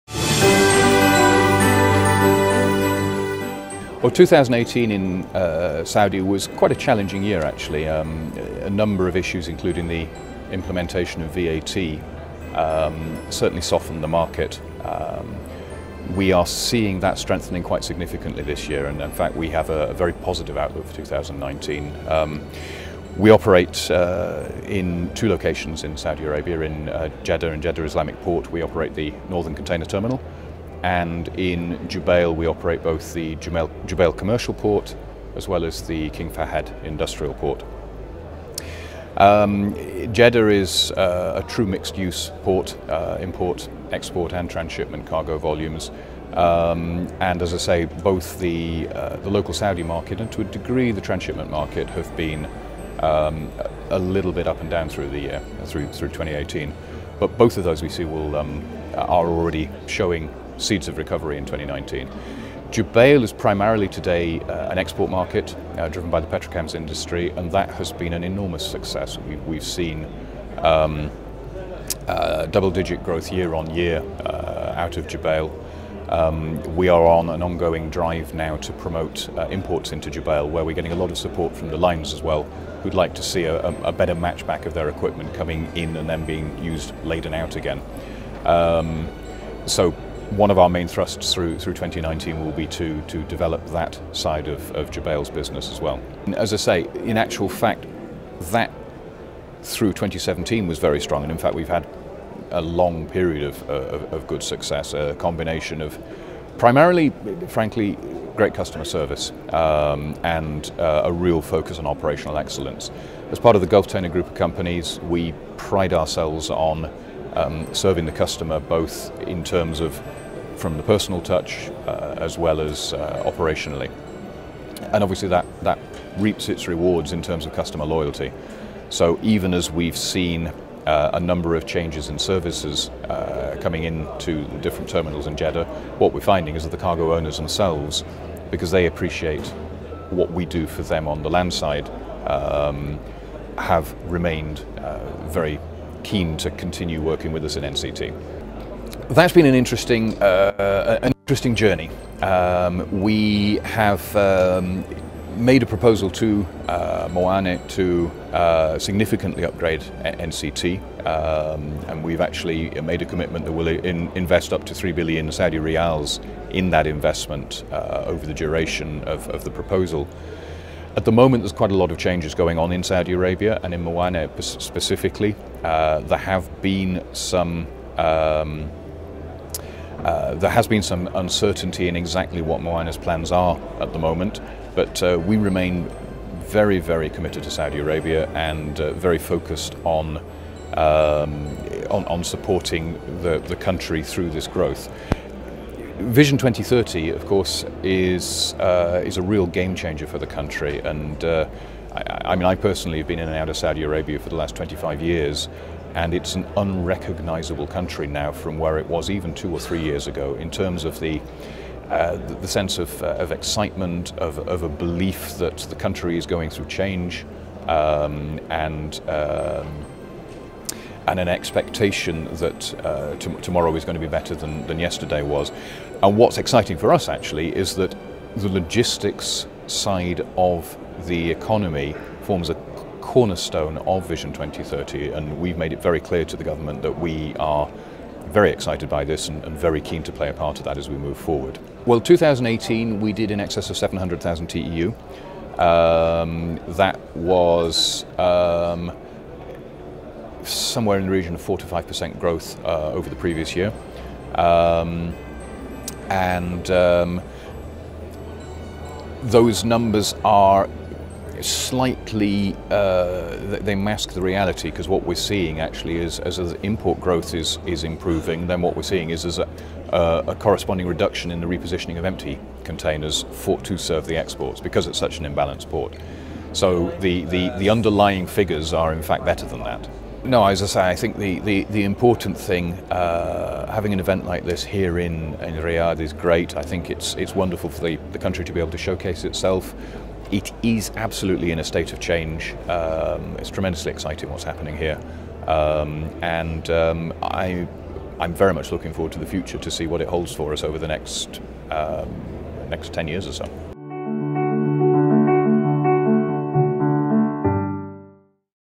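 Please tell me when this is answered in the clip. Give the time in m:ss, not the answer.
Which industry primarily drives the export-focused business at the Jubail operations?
1:06.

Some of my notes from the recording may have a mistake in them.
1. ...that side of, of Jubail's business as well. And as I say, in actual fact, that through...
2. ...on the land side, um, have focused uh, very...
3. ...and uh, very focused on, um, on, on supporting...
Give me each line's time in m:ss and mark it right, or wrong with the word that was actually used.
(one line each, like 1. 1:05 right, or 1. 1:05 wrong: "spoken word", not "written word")
1. 1:33 right
2. 2:21 wrong: "remained", not "focused"
3. 3:08 right.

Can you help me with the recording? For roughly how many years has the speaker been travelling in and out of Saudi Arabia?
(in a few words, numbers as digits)
25 years.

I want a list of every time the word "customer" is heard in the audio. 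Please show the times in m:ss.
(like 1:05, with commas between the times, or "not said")
1:48, 1:58, 2:07.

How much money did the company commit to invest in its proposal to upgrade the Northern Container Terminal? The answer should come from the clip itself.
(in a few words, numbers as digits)
3 billion Saudi riyals.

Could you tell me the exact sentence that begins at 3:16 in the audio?
Vision 2030, of course, is, uh, is a real game changer for the country.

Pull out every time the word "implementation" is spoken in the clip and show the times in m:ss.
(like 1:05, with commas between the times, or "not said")
0:10.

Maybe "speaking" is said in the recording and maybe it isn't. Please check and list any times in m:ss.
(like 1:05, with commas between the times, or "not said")
not said.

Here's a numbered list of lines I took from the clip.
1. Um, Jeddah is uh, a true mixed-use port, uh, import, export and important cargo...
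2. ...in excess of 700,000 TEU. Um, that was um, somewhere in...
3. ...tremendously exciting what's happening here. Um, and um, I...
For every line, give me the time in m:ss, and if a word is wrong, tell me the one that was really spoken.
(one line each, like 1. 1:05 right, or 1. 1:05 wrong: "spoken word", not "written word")
1. 0:39 wrong: "transshipment", not "important"
2. 4:03 right
3. 4:53 right.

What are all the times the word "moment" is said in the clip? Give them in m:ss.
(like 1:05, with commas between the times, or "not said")
2:51, 3:03.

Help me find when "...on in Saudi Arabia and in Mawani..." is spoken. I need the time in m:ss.
2:52.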